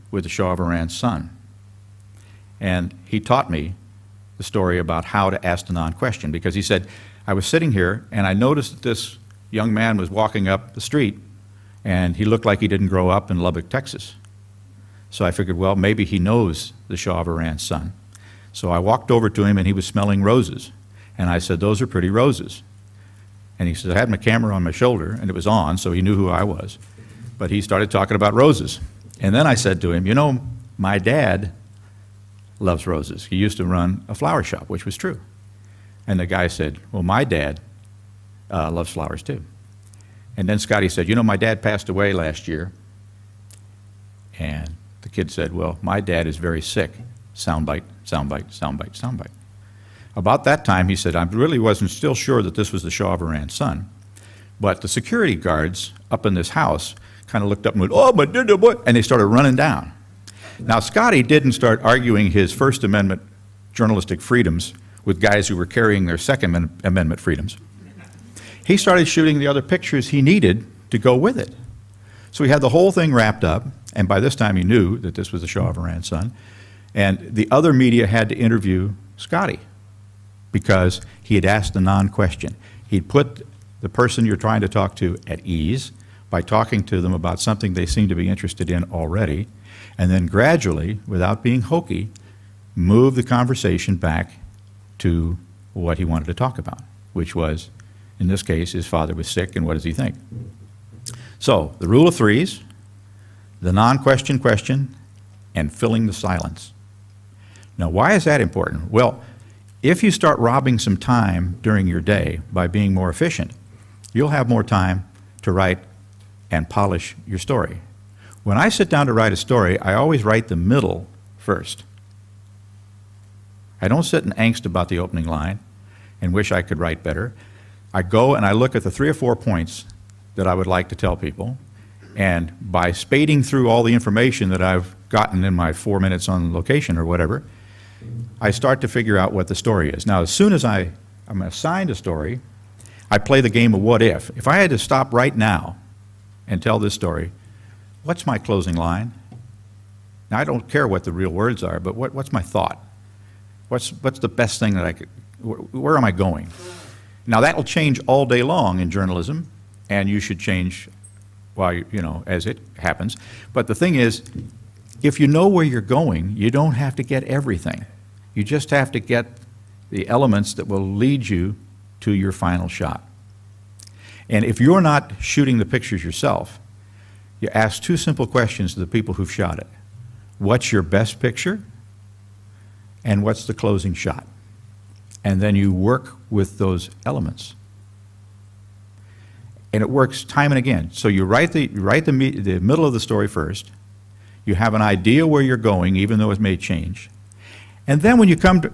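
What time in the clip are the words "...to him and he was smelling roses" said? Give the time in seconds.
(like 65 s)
19 s.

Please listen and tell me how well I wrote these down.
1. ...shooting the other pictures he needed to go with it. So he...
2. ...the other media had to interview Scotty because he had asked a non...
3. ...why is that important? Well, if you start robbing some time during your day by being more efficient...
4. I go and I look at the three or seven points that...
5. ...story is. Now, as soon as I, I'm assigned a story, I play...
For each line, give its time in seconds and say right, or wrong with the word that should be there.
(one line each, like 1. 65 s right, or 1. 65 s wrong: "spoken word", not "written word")
1. 69 s right
2. 77 s right
3. 107 s right
4. 127 s wrong: "four", not "seven"
5. 139 s right.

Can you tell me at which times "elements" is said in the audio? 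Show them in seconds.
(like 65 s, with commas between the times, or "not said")
170 s, 187 s.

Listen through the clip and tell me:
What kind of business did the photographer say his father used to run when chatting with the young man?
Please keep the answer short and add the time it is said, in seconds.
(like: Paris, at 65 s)
flower shop, at 34 s.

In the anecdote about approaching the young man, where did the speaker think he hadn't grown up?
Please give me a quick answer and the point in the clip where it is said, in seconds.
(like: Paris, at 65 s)
Lubbock, Texas, at 13 s.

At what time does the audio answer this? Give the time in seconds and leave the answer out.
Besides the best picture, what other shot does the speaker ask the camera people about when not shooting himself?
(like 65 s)
183 s.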